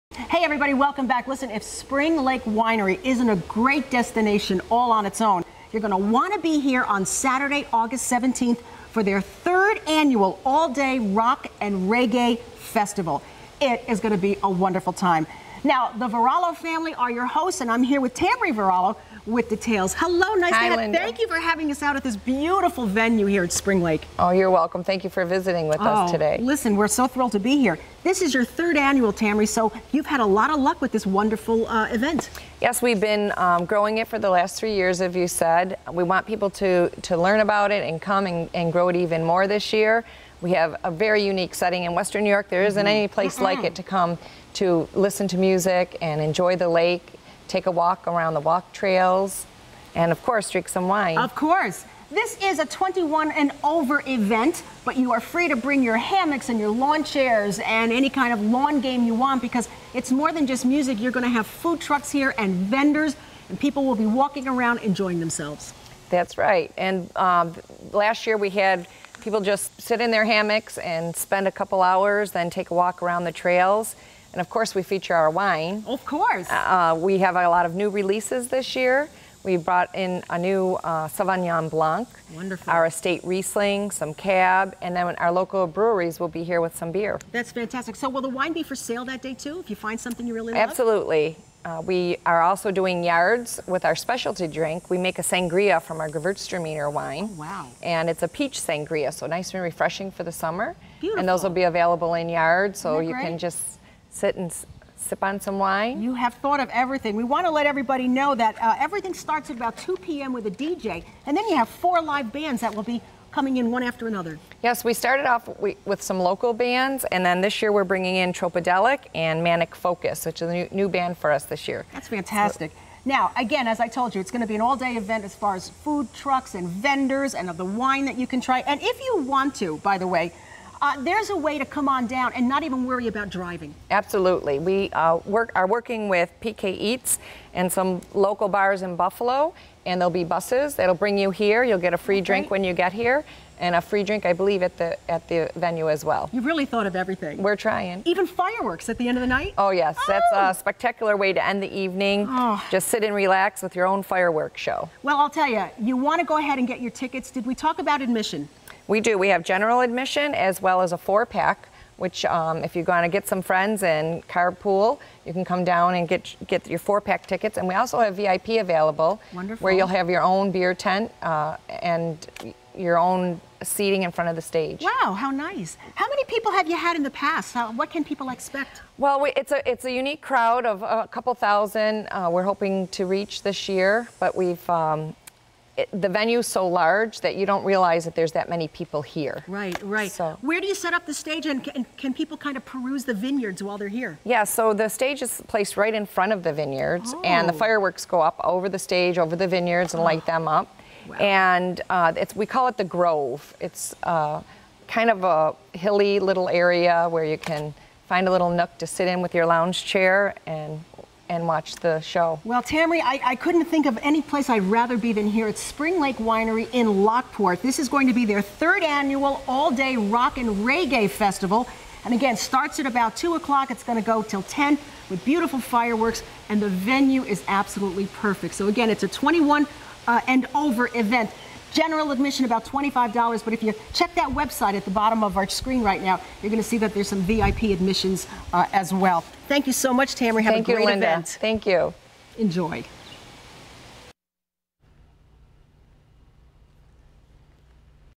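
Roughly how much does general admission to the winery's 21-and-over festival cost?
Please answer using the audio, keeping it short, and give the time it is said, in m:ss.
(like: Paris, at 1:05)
$25, at 3:52.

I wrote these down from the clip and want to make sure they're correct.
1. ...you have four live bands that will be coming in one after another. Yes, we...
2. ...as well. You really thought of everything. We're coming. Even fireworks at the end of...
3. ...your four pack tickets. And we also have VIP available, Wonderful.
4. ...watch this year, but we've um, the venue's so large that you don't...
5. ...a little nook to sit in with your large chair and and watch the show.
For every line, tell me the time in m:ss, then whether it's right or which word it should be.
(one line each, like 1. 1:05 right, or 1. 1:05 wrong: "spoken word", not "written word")
1. 1:51 right
2. 2:25 wrong: "trying", not "coming"
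3. 2:46 right
4. 3:03 wrong: "reach", not "watch"
5. 3:28 wrong: "lounge", not "large".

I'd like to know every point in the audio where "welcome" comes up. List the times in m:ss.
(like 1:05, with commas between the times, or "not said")
0:00, 0:24.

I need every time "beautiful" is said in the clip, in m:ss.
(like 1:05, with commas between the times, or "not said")
0:22, 1:40, 3:45.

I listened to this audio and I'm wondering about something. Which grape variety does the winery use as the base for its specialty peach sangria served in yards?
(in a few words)
Gewürztraminer.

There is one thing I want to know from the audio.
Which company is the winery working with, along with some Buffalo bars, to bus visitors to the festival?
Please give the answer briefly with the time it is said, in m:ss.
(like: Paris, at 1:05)
PK Eats, at 2:16.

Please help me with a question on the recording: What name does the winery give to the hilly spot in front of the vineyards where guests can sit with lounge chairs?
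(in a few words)
The Grove.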